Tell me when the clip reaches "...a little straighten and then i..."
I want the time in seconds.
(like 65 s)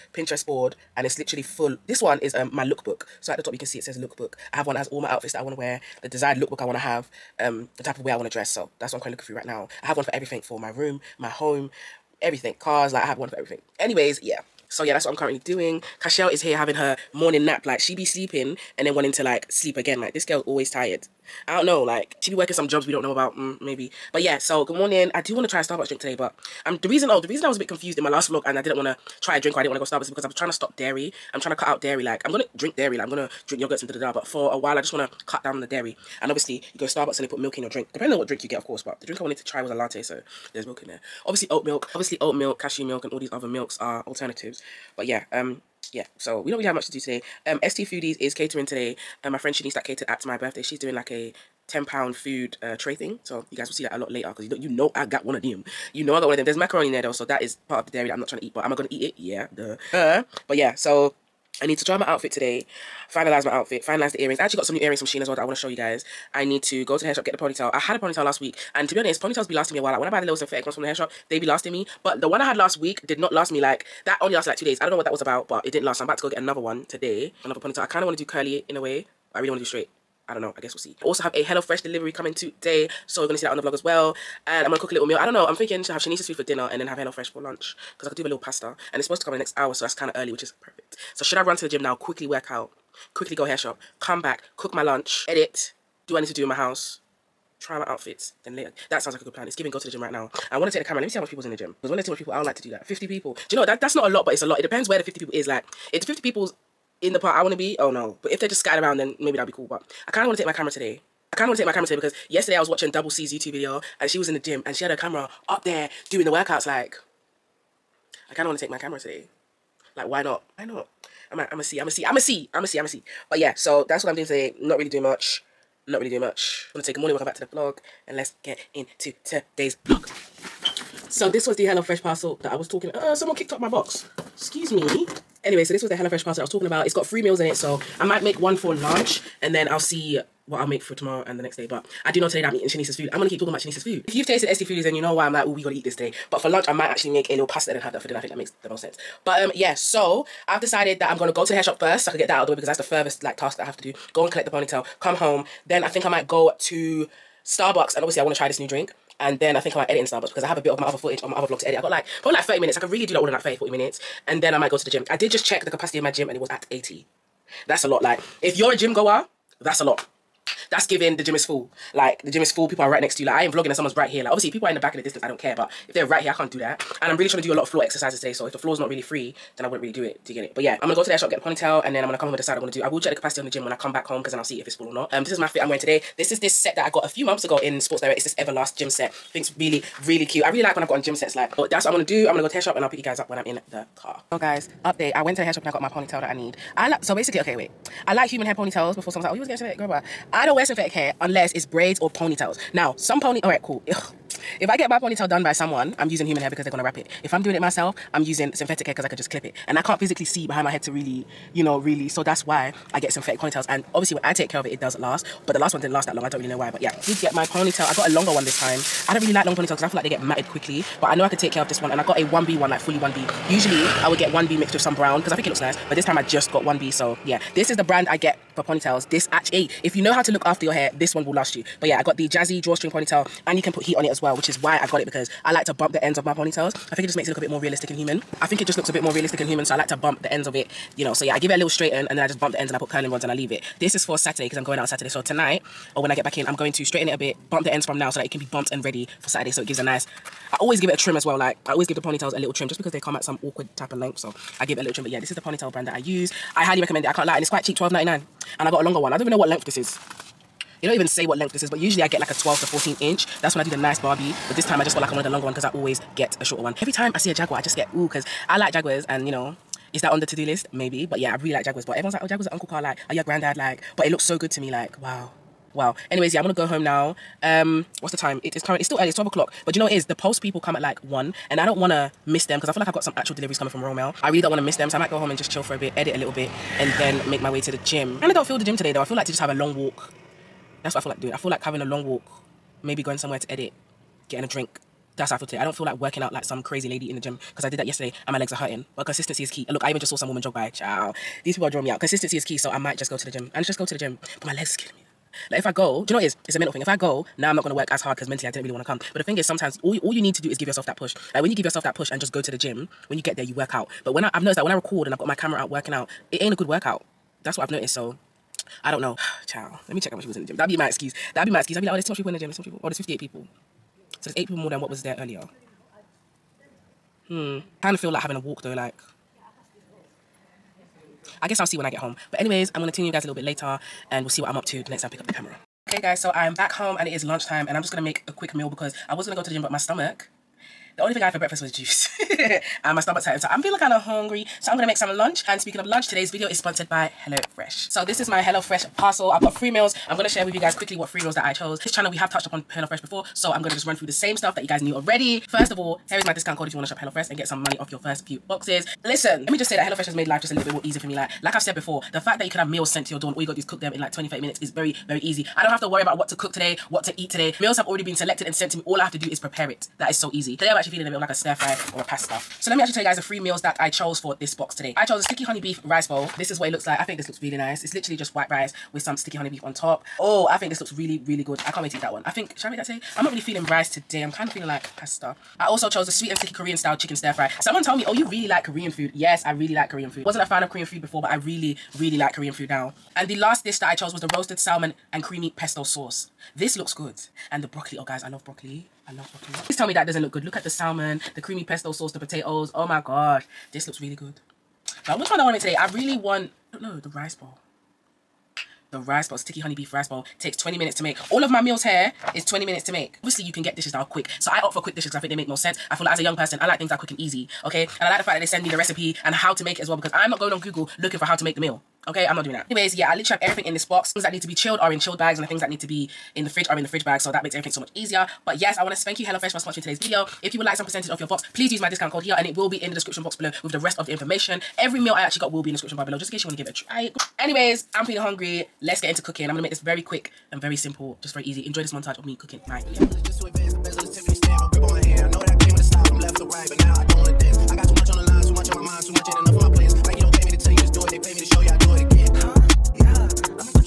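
241 s.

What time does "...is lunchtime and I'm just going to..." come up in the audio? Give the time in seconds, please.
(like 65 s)
337 s.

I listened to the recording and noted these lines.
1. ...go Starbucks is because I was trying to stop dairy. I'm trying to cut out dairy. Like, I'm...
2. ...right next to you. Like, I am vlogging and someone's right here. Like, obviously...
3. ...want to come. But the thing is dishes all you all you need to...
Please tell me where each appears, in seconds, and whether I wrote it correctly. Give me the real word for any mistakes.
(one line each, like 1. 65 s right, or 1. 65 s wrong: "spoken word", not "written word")
1. 29 s right
2. 172 s right
3. 308 s wrong: "sometimes", not "dishes".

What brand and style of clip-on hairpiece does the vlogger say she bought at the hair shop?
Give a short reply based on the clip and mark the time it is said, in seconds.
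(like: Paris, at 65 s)
Jazzy drawstring ponytail, at 232 s.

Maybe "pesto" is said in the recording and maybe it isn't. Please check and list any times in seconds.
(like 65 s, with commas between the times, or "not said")
395 s, 401 s.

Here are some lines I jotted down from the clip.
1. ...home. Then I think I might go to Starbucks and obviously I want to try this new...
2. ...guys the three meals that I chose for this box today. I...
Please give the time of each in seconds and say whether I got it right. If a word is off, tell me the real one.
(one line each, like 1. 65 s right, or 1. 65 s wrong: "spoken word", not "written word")
1. 155 s right
2. 373 s right.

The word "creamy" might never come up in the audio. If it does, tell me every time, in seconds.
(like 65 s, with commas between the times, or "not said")
395 s, 401 s.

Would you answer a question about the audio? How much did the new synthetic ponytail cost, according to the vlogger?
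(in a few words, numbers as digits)
£12.99.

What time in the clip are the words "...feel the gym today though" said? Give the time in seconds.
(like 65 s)
288 s.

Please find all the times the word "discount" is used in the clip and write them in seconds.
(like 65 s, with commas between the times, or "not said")
356 s, 431 s.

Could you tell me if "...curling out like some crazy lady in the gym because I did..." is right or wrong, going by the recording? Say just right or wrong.
wrong.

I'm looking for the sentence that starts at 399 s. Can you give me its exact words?
Please tell me that doesn't look good.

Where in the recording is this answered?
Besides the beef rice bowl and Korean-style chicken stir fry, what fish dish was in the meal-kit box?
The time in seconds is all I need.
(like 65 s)
394 s.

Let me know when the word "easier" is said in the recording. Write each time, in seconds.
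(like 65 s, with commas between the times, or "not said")
360 s, 427 s.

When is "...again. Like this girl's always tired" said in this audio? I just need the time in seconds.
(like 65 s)
19 s.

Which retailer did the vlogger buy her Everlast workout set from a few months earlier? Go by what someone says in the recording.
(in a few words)
Sports Direct.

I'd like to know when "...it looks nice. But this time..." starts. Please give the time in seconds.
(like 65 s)
225 s.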